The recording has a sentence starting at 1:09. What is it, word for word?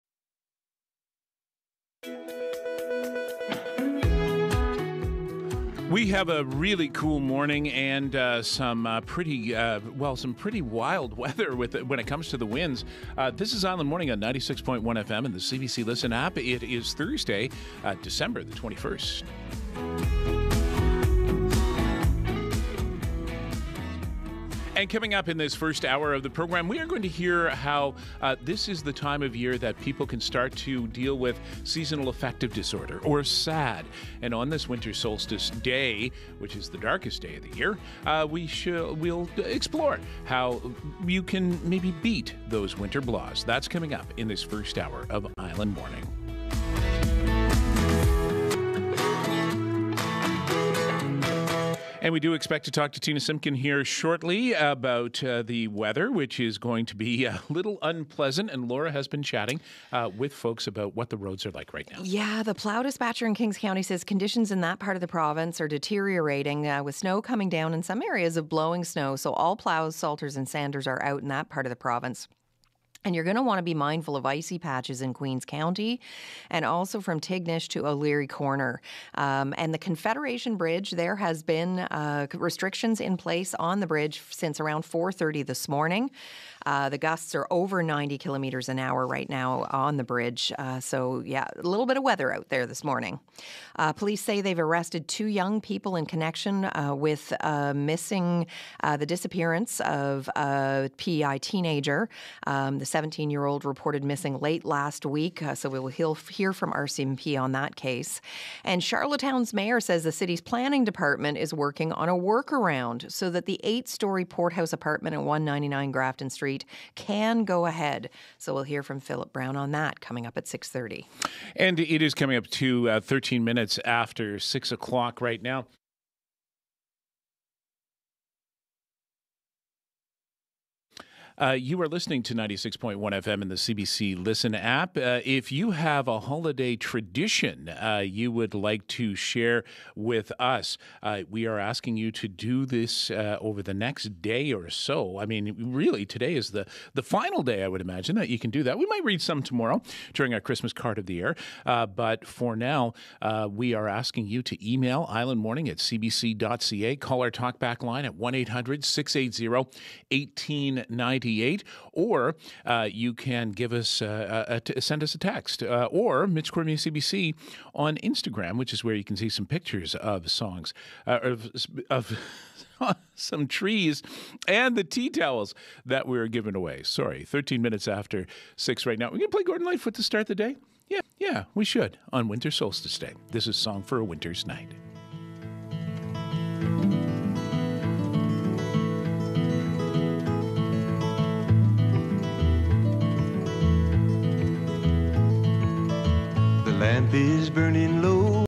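So all plows, salters, and sanders are out in that part of the province.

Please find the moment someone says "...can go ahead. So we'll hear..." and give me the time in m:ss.
1:56.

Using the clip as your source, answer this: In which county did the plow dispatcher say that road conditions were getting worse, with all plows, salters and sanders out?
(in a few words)
Kings County.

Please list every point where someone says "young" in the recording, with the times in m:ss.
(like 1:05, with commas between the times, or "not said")
1:35.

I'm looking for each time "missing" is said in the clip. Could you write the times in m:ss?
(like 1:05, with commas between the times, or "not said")
1:37, 1:44.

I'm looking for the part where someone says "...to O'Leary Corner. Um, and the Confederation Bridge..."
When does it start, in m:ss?
1:17.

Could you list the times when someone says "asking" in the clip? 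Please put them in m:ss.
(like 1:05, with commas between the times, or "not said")
2:21, 2:33.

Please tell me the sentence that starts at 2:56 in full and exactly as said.
Sorry, 13 minutes after six right now.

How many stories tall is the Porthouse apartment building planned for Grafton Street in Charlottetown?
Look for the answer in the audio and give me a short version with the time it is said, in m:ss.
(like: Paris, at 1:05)
8, at 1:53.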